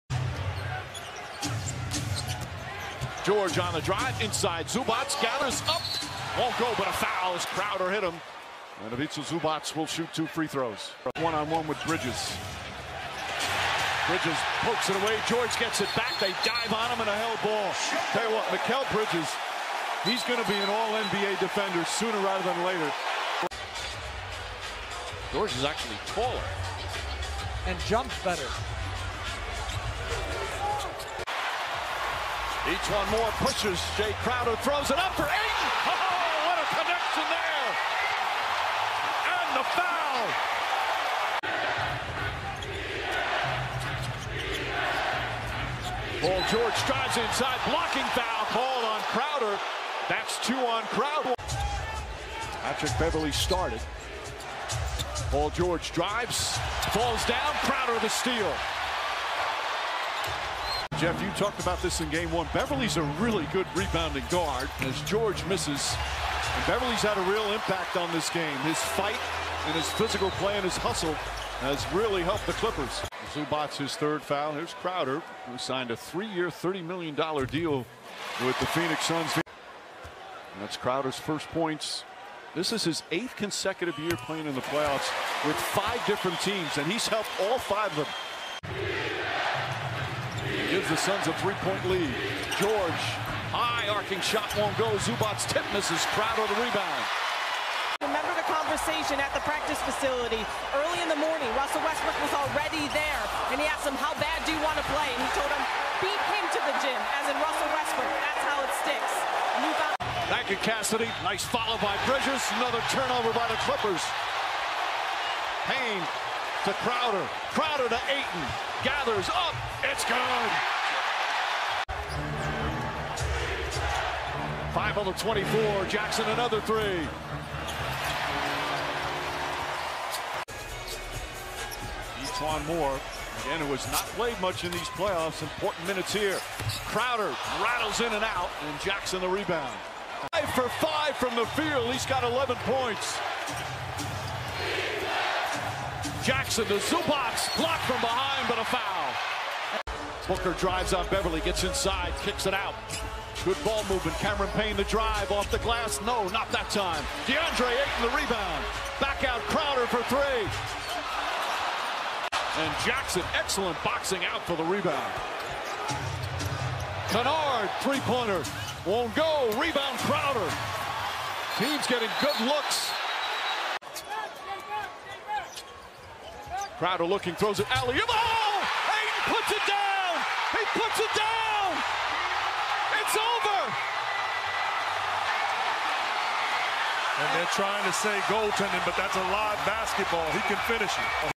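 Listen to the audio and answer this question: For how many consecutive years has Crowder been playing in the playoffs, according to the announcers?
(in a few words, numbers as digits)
8.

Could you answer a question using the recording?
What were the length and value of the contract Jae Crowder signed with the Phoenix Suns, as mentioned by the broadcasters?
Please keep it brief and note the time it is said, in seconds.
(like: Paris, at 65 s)
3-year, $30 million, at 75 s.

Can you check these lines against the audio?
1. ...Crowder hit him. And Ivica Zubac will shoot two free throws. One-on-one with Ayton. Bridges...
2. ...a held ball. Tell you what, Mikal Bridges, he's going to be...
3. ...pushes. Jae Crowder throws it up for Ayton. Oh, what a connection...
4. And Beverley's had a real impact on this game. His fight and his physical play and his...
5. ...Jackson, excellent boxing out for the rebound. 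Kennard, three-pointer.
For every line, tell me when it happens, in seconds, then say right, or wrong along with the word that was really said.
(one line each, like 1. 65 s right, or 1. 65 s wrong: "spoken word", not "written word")
1. 7 s wrong: "Bridges", not "Ayton"
2. 17 s right
3. 33 s right
4. 66 s right
5. 162 s right.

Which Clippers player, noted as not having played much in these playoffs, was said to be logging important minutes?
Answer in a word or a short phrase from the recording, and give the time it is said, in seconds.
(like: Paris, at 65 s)
E'Twaun Moore, at 132 s.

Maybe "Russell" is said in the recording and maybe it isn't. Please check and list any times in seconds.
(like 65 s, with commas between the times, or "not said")
101 s, 107 s.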